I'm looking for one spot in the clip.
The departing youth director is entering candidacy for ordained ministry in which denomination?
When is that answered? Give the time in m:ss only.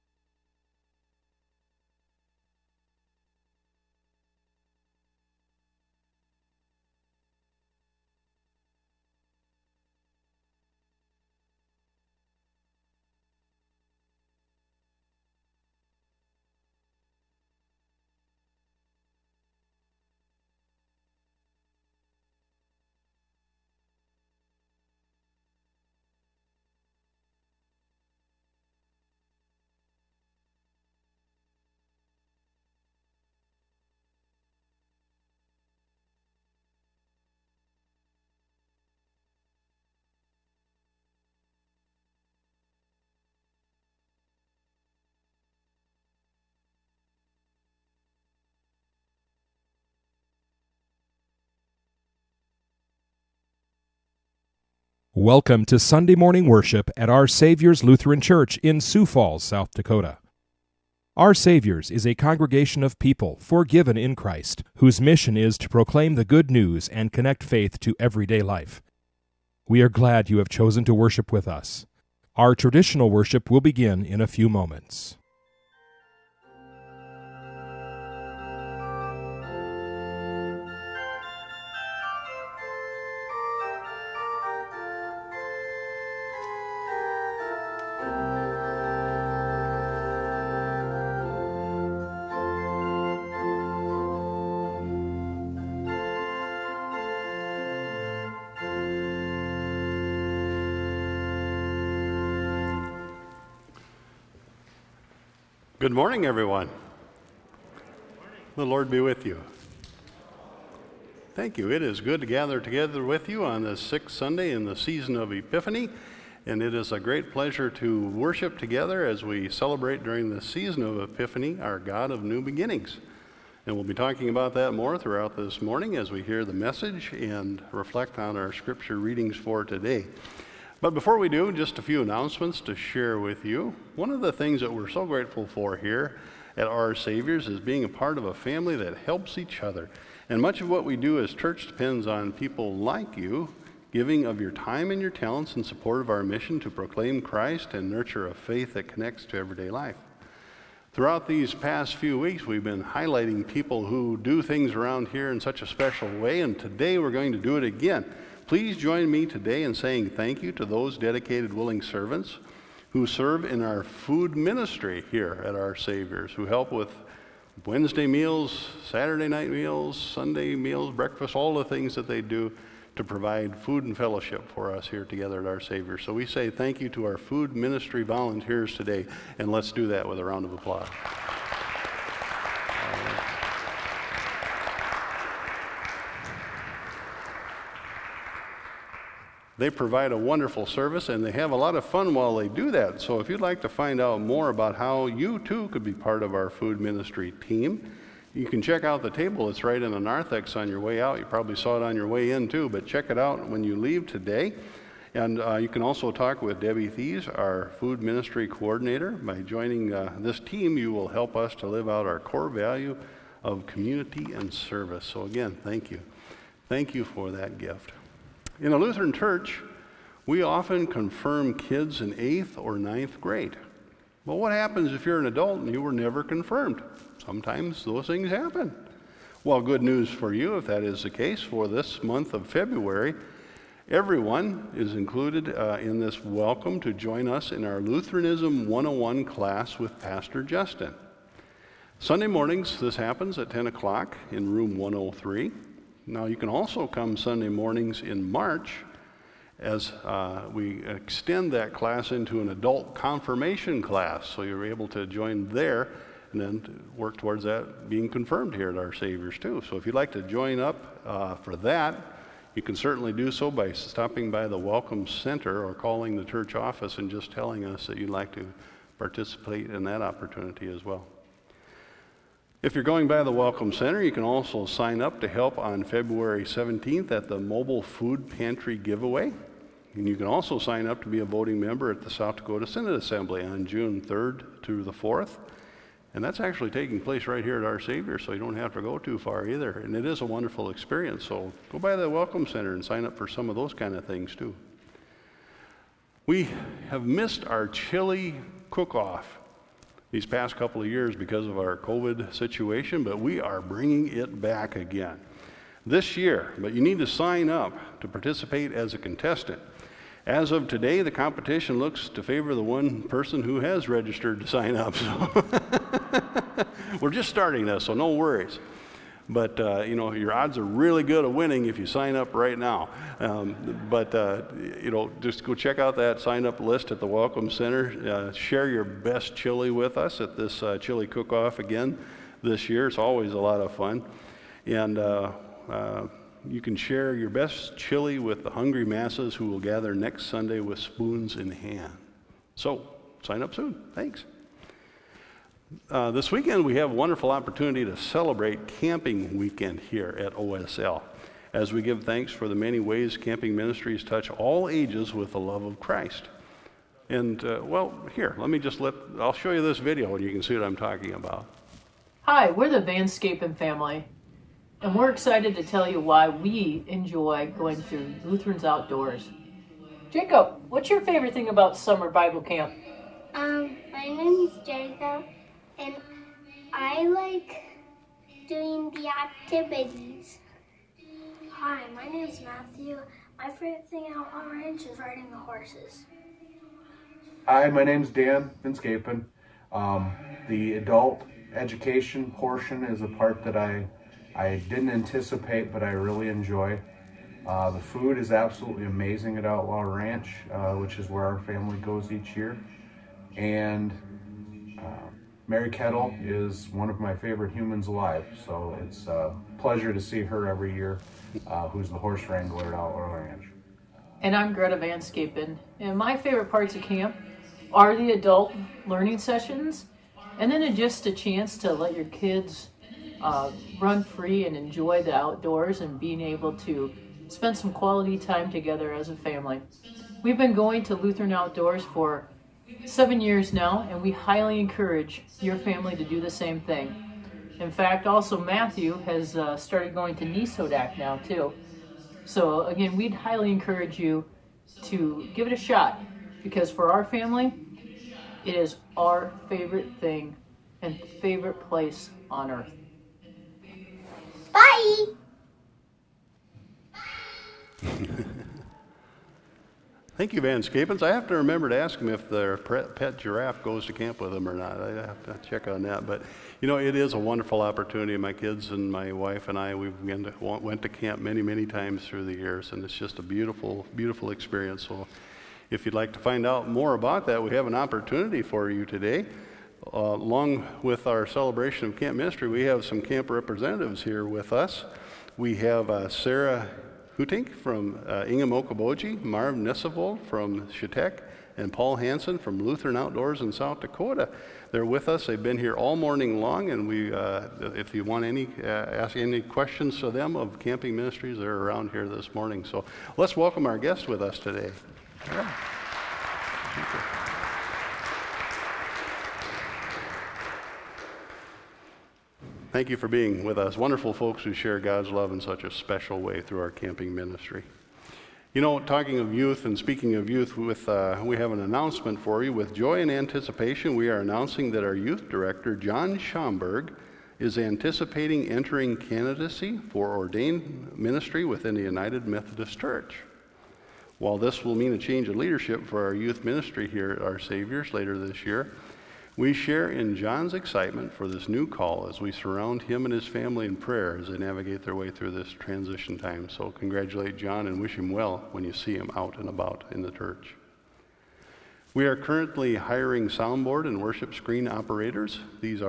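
8:51.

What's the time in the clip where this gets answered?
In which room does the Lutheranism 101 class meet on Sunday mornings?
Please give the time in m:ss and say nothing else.
4:04.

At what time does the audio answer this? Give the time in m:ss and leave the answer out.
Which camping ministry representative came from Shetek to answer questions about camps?
8:09.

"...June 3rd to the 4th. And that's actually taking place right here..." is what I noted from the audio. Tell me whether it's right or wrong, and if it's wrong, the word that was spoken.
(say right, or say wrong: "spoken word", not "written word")
right.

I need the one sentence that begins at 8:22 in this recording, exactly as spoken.
So let's welcome our guests with us today.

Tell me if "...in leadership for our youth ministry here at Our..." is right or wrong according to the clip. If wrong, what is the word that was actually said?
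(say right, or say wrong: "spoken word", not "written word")
right.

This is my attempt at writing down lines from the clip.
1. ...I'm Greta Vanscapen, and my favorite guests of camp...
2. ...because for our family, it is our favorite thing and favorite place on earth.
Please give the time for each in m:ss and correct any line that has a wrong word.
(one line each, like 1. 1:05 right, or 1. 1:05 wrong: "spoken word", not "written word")
1. 6:54 wrong: "parts", not "guests"
2. 7:26 right.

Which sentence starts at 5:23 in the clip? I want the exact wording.
Um, but uh, you know, just go check out that sign up list at the Welcome Center.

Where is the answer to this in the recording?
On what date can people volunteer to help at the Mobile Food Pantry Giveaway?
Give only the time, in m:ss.
4:35.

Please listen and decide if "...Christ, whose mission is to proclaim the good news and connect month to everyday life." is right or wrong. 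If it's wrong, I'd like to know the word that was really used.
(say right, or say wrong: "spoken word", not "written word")
wrong: "faith", not "month".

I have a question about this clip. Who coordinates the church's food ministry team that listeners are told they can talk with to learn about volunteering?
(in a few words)
Debbie Thies.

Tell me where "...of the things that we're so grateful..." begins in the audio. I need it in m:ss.
2:14.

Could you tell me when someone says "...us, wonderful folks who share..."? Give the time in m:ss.
8:33.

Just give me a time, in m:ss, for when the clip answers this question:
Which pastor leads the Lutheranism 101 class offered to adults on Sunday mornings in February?
3:59.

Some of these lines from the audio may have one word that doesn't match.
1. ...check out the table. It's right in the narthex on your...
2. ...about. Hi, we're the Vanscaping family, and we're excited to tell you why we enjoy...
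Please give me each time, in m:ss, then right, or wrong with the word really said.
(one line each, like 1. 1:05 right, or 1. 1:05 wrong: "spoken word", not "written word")
1. 3:18 right
2. 6:01 right.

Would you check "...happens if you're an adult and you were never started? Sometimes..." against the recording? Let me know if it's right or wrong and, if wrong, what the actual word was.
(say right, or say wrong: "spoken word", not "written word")
wrong: "confirmed", not "started".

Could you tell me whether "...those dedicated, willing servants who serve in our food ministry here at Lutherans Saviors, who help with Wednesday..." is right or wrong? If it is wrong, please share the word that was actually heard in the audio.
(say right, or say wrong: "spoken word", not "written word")
wrong: "Our", not "Lutherans".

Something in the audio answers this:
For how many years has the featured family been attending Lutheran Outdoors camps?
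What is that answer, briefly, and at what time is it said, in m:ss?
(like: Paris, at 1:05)
7, at 7:12.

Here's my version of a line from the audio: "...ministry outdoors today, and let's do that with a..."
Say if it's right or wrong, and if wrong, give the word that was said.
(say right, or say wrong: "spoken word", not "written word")
wrong: "volunteers", not "outdoors".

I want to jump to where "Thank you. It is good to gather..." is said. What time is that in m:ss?
1:51.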